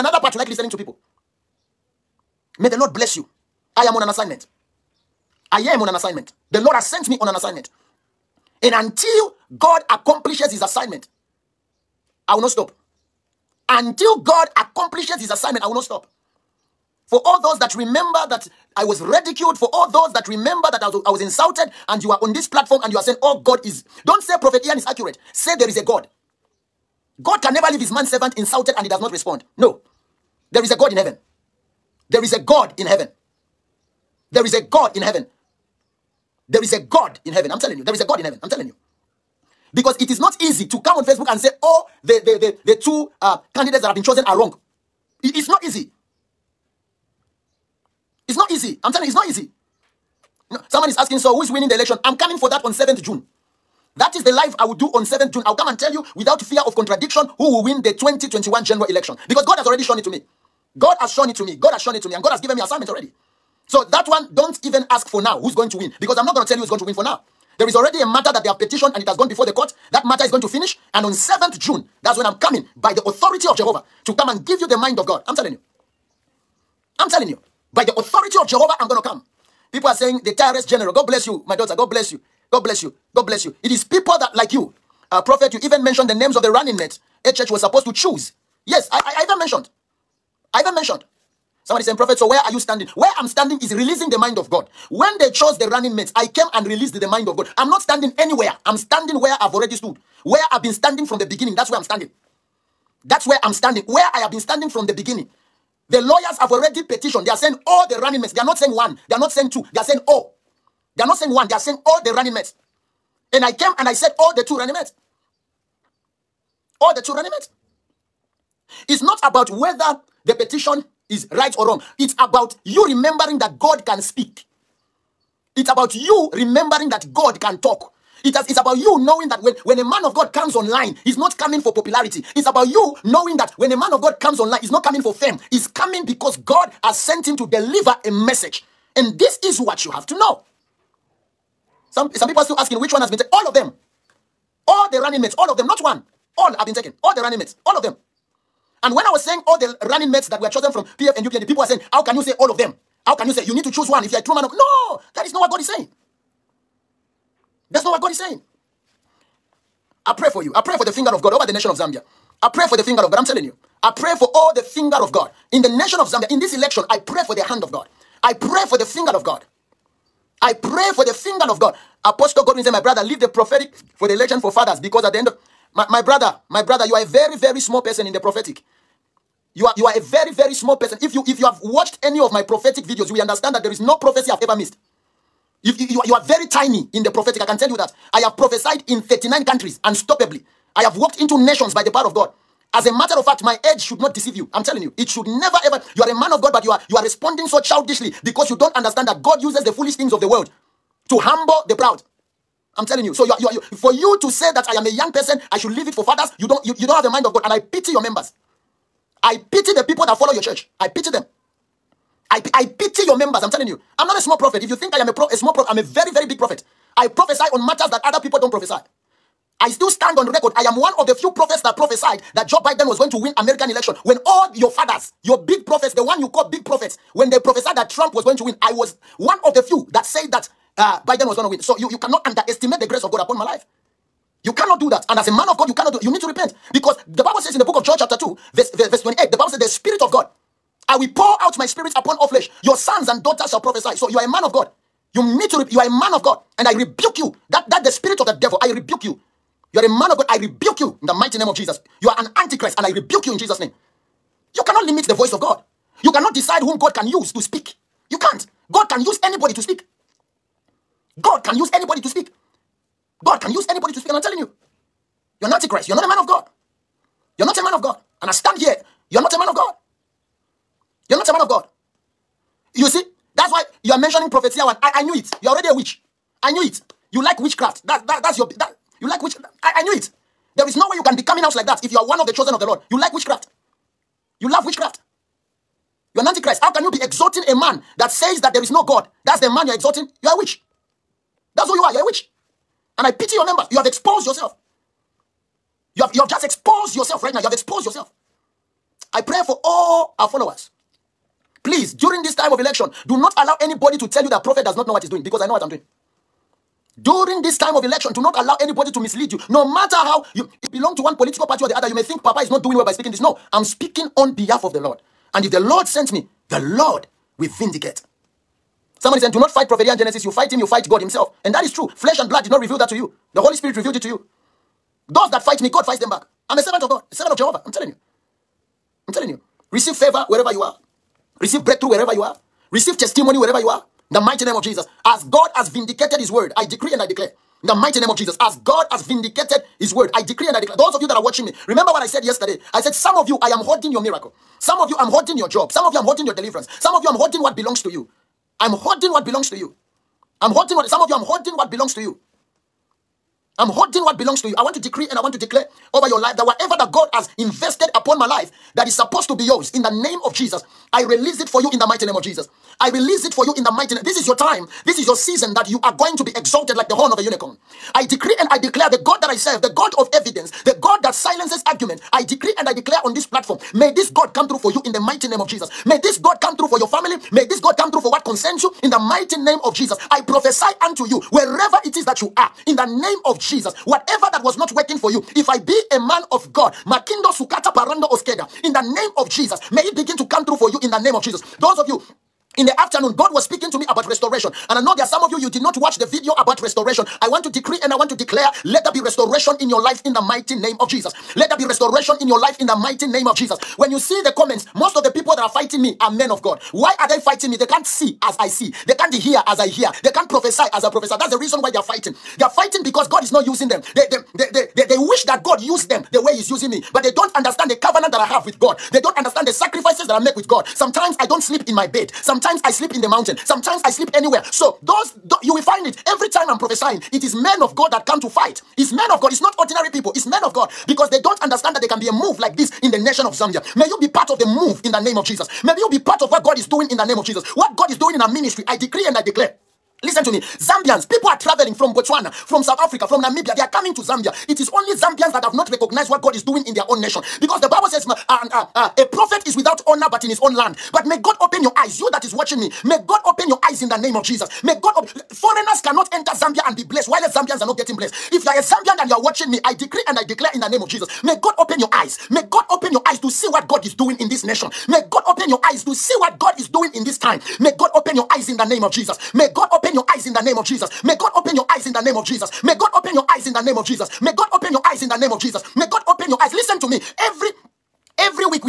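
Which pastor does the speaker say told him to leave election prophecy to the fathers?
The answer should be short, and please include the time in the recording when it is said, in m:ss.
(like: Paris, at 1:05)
Apostle Godwin, at 2:52.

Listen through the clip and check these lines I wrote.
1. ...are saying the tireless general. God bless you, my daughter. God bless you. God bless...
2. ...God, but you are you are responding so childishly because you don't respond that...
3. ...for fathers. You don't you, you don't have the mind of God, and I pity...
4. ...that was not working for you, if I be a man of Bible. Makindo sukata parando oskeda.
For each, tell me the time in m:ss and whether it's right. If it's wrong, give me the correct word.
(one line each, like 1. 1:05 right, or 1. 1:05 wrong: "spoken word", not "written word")
1. 1:19 right
2. 3:16 wrong: "understand", not "respond"
3. 3:25 right
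4. 6:24 wrong: "God", not "Bible".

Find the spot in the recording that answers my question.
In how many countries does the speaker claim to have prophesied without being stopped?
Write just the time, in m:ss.
3:09.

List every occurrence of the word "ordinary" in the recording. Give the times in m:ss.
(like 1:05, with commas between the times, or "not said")
7:09.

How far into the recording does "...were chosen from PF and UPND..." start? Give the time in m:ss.
2:30.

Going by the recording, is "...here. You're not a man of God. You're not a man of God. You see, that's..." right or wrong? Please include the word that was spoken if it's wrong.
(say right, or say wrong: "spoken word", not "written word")
right.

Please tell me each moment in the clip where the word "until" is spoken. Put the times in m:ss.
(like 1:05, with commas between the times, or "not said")
0:08, 0:13.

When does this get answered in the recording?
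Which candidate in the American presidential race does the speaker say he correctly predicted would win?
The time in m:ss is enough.
3:42.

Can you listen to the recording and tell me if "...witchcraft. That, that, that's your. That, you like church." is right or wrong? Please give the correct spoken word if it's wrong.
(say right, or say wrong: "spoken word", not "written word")
wrong: "witch", not "church".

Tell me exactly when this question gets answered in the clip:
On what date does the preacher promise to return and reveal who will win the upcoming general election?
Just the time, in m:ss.
0:52.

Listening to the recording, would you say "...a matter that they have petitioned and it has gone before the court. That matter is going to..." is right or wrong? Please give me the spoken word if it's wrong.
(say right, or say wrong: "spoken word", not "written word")
right.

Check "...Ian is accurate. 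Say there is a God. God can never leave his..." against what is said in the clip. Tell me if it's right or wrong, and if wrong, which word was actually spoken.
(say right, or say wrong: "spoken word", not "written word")
right.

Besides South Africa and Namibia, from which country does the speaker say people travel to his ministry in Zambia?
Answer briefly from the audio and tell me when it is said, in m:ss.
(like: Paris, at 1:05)
Botswana, at 7:21.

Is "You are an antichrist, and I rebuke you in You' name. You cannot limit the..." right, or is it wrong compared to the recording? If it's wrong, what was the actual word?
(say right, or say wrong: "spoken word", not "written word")
wrong: "Jesus", not "You".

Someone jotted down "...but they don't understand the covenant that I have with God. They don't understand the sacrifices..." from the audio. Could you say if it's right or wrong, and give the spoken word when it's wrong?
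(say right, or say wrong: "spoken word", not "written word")
right.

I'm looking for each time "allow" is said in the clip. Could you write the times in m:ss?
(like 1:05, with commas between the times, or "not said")
5:03, 5:08.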